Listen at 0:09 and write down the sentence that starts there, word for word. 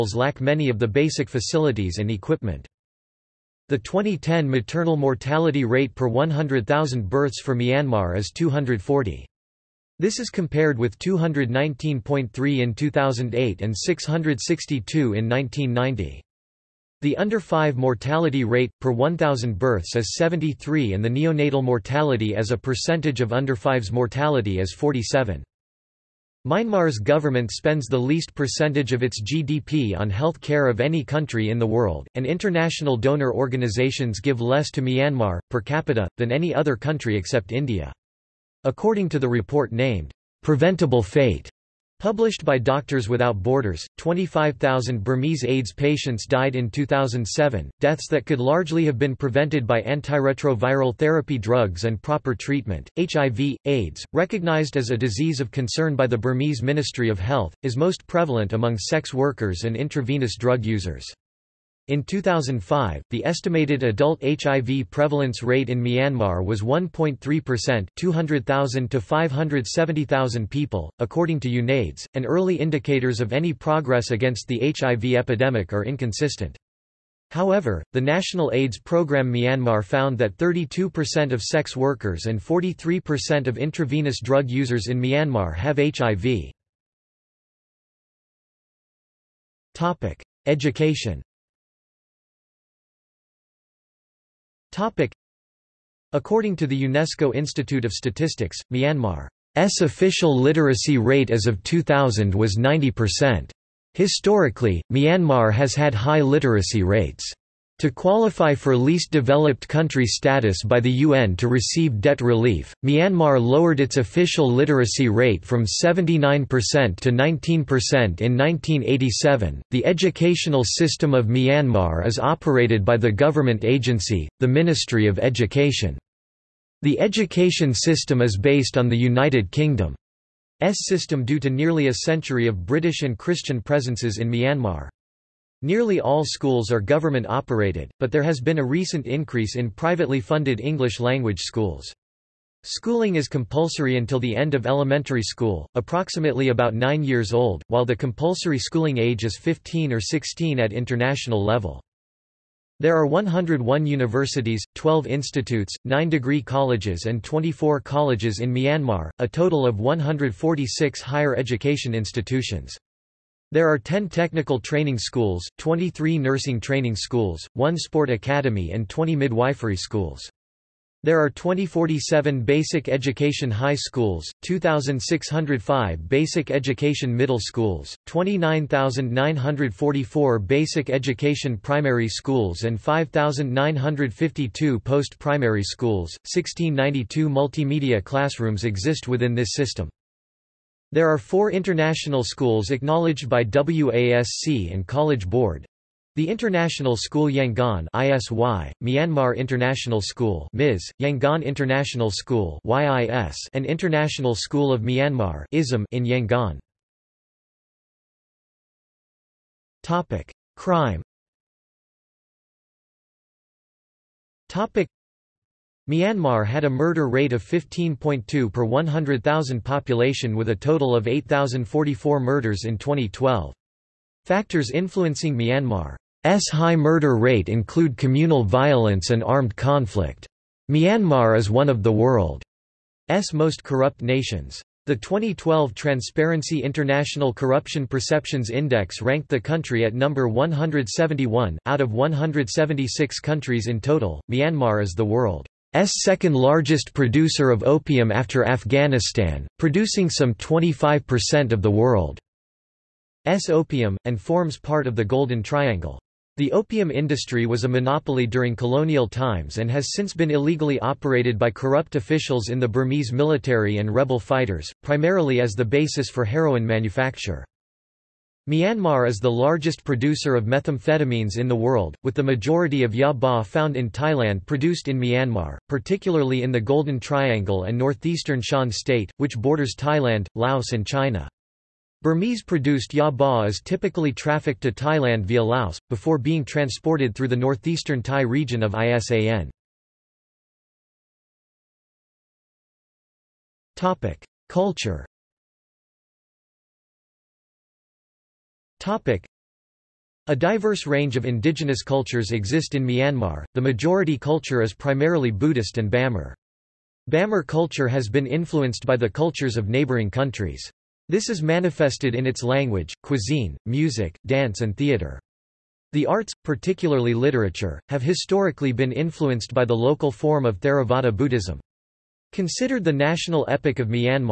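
This is compared with 219.3 in 2008 and 662 in 1990.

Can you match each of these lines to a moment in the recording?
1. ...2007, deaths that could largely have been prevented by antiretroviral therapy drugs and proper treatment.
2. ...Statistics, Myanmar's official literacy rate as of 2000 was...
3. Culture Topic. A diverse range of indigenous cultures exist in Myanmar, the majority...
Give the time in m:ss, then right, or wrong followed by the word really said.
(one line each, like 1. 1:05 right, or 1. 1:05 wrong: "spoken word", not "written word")
1. 0:46 right
2. 1:37 right
3. 4:54 right.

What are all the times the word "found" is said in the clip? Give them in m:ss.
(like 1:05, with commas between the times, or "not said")
1:19, 4:33.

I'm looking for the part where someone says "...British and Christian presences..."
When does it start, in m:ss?
2:12.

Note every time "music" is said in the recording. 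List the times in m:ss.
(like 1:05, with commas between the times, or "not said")
5:13.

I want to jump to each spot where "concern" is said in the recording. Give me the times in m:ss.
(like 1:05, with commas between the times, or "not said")
0:55.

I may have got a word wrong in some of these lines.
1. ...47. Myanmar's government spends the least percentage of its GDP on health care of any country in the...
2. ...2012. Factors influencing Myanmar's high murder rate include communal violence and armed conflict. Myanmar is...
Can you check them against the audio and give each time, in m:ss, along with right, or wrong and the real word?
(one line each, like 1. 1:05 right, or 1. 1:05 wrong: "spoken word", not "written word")
1. 0:24 right
2. 3:42 right.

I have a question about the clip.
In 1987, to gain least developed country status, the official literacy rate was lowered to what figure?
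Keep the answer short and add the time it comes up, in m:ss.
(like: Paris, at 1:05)
19%, at 1:57.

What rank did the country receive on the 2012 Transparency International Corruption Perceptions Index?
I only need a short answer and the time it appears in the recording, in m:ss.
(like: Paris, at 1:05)
171, at 4:00.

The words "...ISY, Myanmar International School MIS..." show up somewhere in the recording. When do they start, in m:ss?
3:17.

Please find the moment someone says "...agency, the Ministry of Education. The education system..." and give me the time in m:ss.
2:03.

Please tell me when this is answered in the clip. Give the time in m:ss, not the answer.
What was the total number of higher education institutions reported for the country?
2:39.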